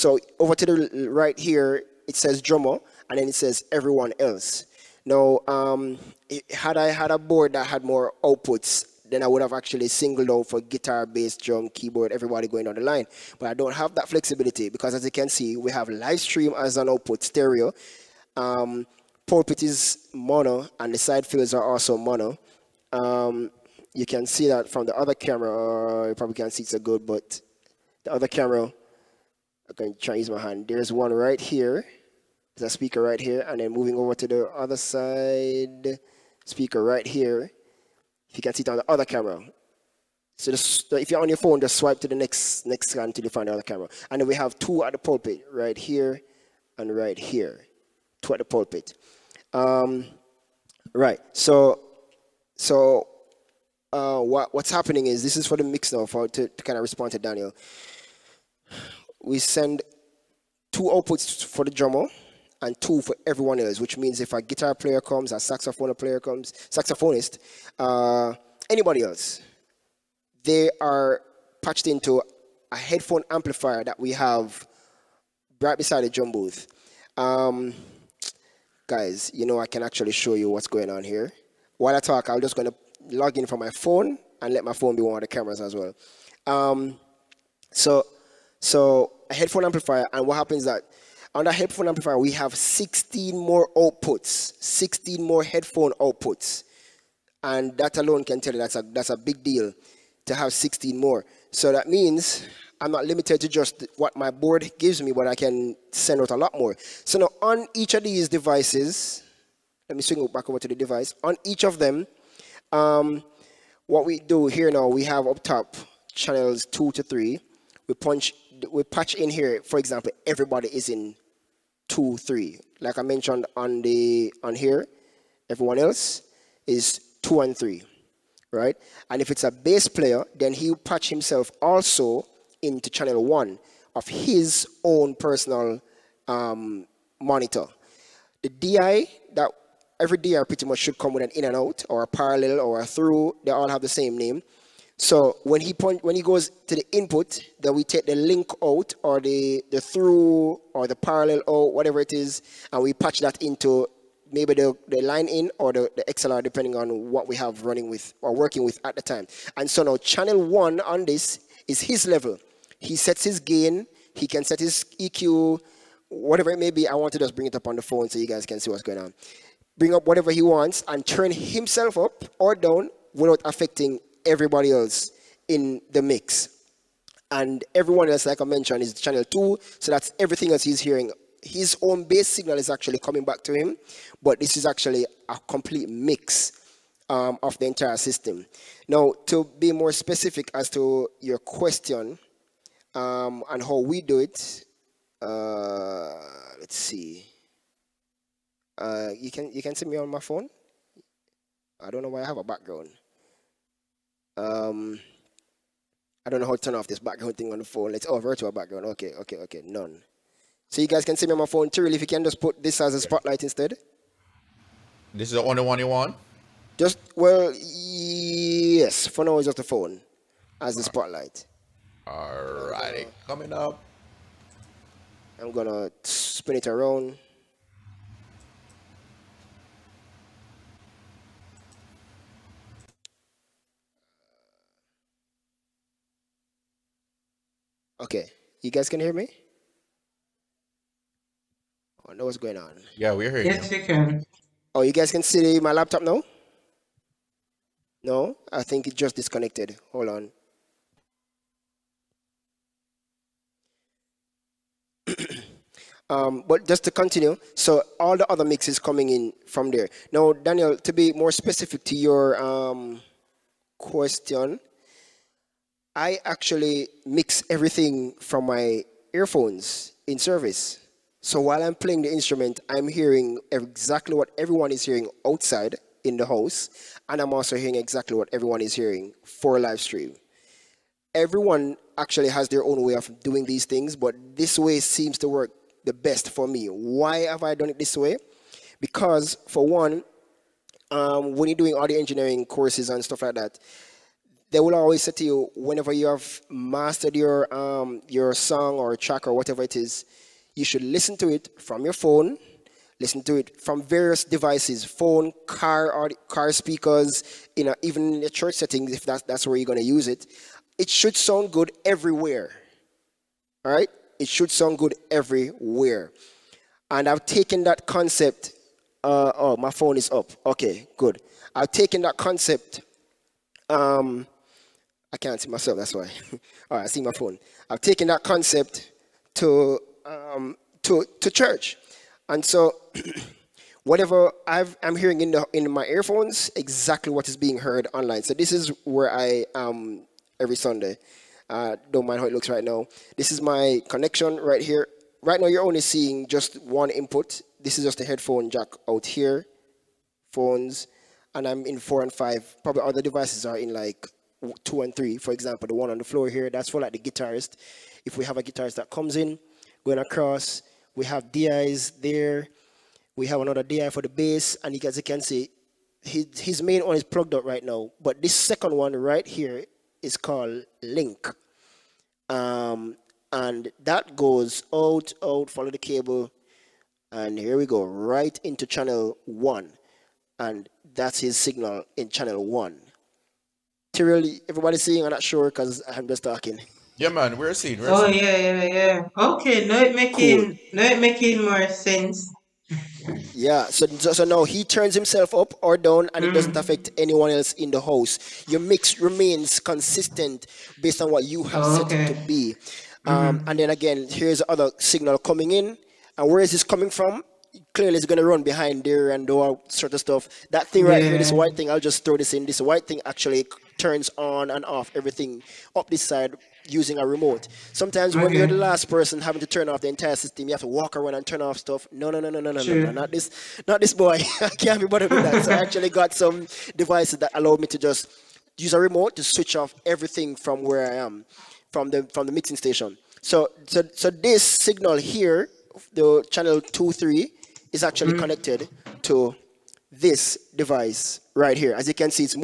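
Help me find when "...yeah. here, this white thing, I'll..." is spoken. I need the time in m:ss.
6:51.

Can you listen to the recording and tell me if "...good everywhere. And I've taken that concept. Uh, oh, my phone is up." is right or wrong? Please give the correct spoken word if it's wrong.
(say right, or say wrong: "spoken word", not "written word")
right.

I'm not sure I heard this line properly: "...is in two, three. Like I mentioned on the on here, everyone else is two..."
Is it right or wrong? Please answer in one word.
right.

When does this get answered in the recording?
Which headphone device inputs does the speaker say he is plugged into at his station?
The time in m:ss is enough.
5:51.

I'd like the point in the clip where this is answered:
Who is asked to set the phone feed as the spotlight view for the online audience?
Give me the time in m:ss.
3:31.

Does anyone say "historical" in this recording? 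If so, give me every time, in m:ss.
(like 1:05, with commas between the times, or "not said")
not said.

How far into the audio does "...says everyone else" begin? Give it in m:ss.
0:03.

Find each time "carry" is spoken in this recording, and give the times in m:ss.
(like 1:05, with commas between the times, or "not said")
not said.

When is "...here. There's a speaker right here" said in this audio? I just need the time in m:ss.
0:31.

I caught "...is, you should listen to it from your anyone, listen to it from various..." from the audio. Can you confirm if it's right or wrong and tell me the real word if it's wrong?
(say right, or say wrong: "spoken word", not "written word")
wrong: "phone", not "anyone".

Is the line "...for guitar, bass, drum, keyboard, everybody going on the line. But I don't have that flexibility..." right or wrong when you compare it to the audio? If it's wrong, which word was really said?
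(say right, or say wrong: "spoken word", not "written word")
right.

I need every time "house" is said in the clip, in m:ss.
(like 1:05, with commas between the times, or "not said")
4:36, 6:37.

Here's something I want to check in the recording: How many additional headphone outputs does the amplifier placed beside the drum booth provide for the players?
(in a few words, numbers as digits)
16.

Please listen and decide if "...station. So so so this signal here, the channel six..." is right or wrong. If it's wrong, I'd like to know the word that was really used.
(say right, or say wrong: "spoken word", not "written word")
wrong: "two", not "six".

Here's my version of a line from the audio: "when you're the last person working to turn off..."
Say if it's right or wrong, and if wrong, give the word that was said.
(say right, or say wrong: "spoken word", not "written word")
wrong: "having", not "working".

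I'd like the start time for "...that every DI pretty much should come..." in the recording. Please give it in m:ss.
2:19.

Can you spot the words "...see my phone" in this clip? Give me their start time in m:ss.
5:26.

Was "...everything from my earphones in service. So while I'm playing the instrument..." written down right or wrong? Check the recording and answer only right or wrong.
right.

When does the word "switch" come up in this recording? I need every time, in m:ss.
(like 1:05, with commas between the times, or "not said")
7:09.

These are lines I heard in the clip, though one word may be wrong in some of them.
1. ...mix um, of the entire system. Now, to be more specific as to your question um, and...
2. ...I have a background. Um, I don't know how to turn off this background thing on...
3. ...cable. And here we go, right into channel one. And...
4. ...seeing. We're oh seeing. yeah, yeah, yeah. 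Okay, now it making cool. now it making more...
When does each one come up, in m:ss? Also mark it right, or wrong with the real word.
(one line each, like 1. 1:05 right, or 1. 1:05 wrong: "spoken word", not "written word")
1. 3:05 right
2. 3:22 right
3. 6:15 right
4. 6:27 right.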